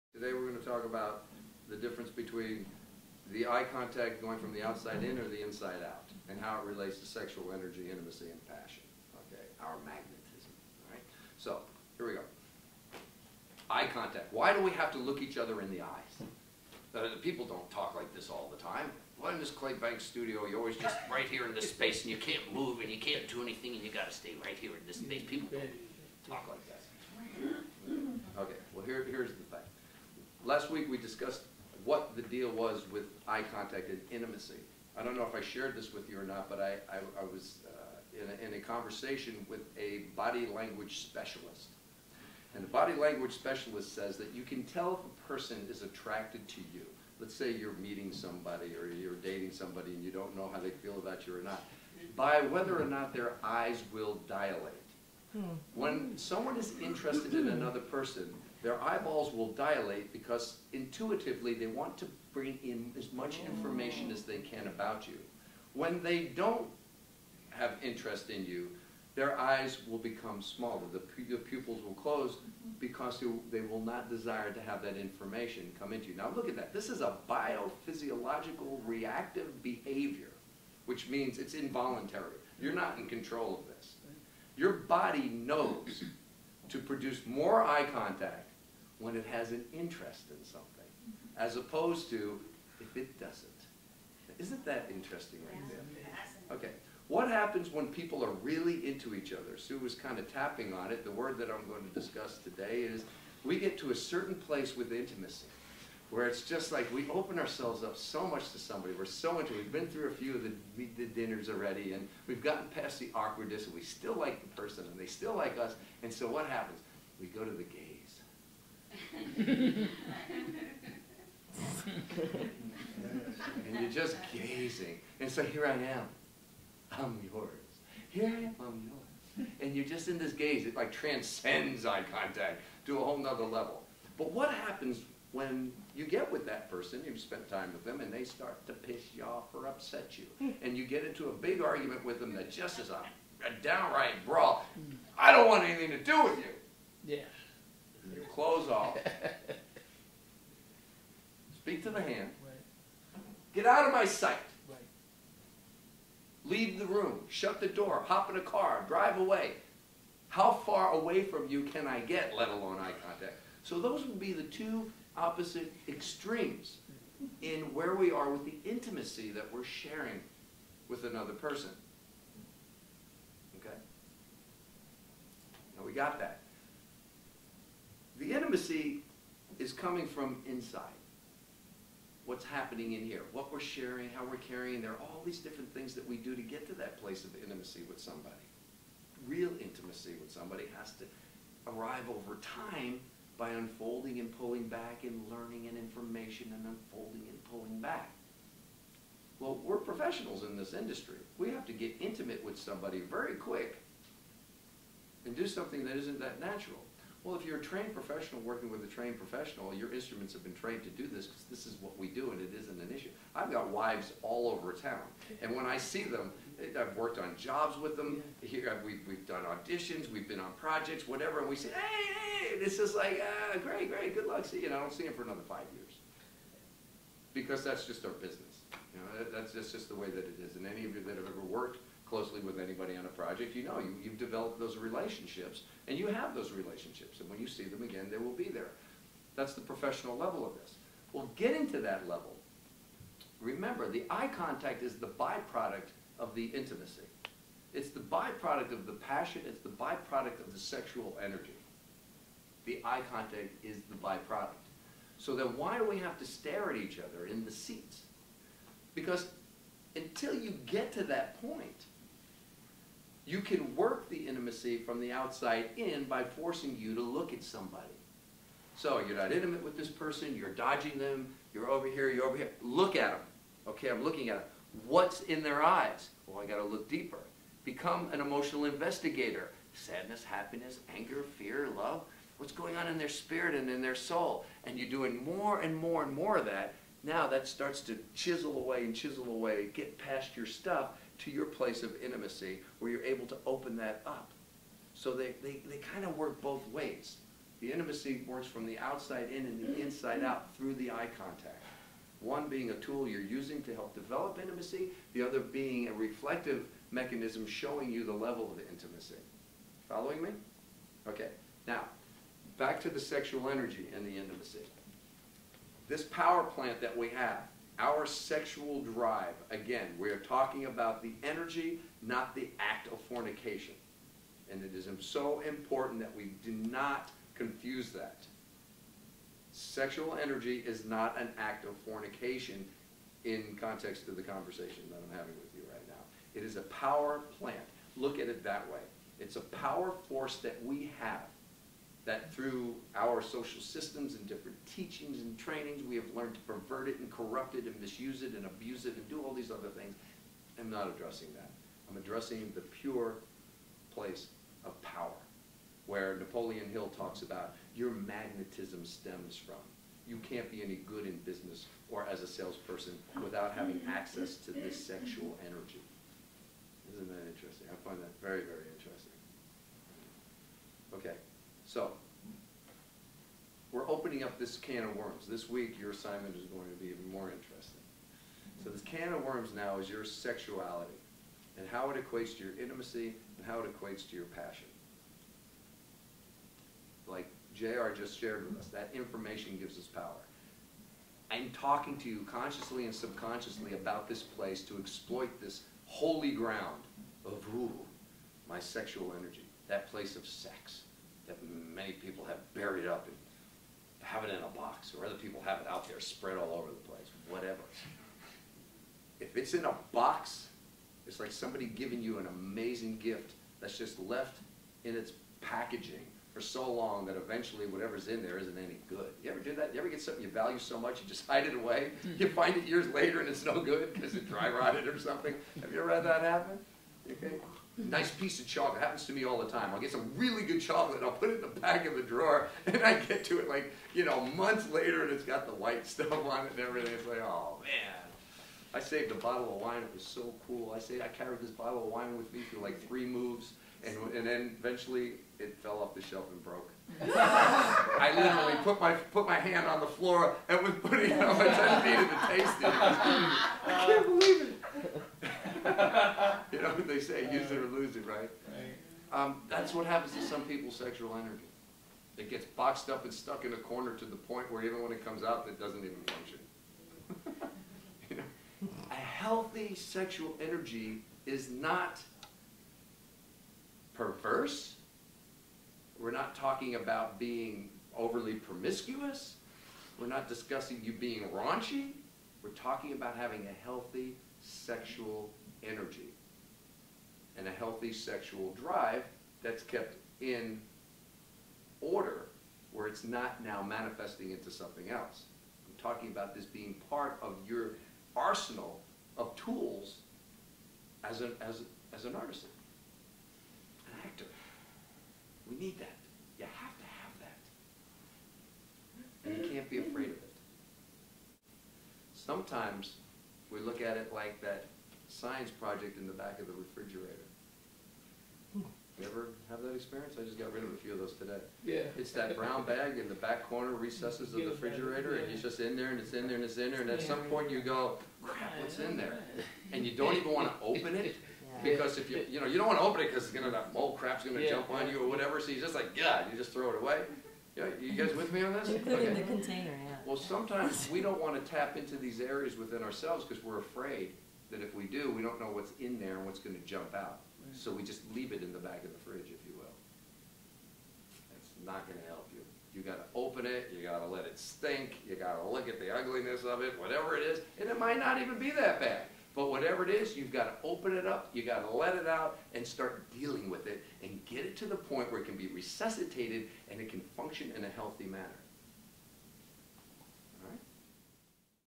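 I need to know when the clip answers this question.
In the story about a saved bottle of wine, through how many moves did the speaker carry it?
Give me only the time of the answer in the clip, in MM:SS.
07:22.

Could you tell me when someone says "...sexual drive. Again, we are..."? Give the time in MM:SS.
05:18.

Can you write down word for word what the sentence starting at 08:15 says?
I'm talking about this being part of your arsenal of tools as an, as, as an artist, an actor.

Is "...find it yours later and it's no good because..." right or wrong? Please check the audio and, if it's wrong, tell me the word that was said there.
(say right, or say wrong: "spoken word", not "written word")
wrong: "years", not "yours".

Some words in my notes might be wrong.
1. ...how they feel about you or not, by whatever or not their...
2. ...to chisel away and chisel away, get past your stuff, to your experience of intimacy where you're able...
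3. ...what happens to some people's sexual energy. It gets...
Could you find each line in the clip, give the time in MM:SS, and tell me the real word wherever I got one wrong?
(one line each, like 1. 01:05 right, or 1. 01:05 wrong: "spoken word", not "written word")
1. 00:50 wrong: "whether", not "whatever"
2. 04:47 wrong: "place", not "experience"
3. 07:39 right.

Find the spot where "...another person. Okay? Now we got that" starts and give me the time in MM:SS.
02:51.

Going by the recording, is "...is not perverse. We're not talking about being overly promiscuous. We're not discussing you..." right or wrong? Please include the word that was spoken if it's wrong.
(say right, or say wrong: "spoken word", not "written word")
right.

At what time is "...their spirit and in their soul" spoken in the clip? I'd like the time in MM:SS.
04:42.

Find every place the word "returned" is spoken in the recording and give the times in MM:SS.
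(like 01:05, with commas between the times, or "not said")
not said.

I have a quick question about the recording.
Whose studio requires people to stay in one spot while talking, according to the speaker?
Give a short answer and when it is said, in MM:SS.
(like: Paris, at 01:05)
Clay Banks, at 00:19.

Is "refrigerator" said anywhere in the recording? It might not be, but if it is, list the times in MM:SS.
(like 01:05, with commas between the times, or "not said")
08:36, 08:44.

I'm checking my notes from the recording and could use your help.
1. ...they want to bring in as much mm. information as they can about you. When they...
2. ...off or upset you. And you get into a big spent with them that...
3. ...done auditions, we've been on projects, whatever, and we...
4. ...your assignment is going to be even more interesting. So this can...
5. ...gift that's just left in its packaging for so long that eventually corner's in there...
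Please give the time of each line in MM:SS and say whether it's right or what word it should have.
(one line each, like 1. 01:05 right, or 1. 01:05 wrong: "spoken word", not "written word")
1. 01:01 right
2. 02:19 wrong: "argument", not "spent"
3. 03:39 right
4. 06:15 right
5. 06:52 wrong: "whatever", not "corner".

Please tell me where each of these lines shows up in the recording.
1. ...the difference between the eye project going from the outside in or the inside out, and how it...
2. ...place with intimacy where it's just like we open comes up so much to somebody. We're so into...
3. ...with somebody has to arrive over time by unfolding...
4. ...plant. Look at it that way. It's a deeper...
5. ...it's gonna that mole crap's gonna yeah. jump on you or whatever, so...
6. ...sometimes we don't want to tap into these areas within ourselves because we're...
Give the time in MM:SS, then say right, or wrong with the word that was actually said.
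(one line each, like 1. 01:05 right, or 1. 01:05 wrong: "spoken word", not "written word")
1. 00:01 wrong: "contact", not "project"
2. 01:44 wrong: "ourselves", not "comes"
3. 03:10 right
4. 05:37 wrong: "power", not "deeper"
5. 08:53 right
6. 09:00 right.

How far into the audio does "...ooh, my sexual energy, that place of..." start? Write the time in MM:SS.
06:37.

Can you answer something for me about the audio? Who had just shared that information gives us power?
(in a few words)
JR.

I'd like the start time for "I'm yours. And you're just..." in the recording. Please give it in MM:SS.
02:08.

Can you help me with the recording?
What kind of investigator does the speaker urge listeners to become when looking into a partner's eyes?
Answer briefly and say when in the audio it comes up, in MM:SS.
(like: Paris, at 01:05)
Emotional investigator, at 04:38.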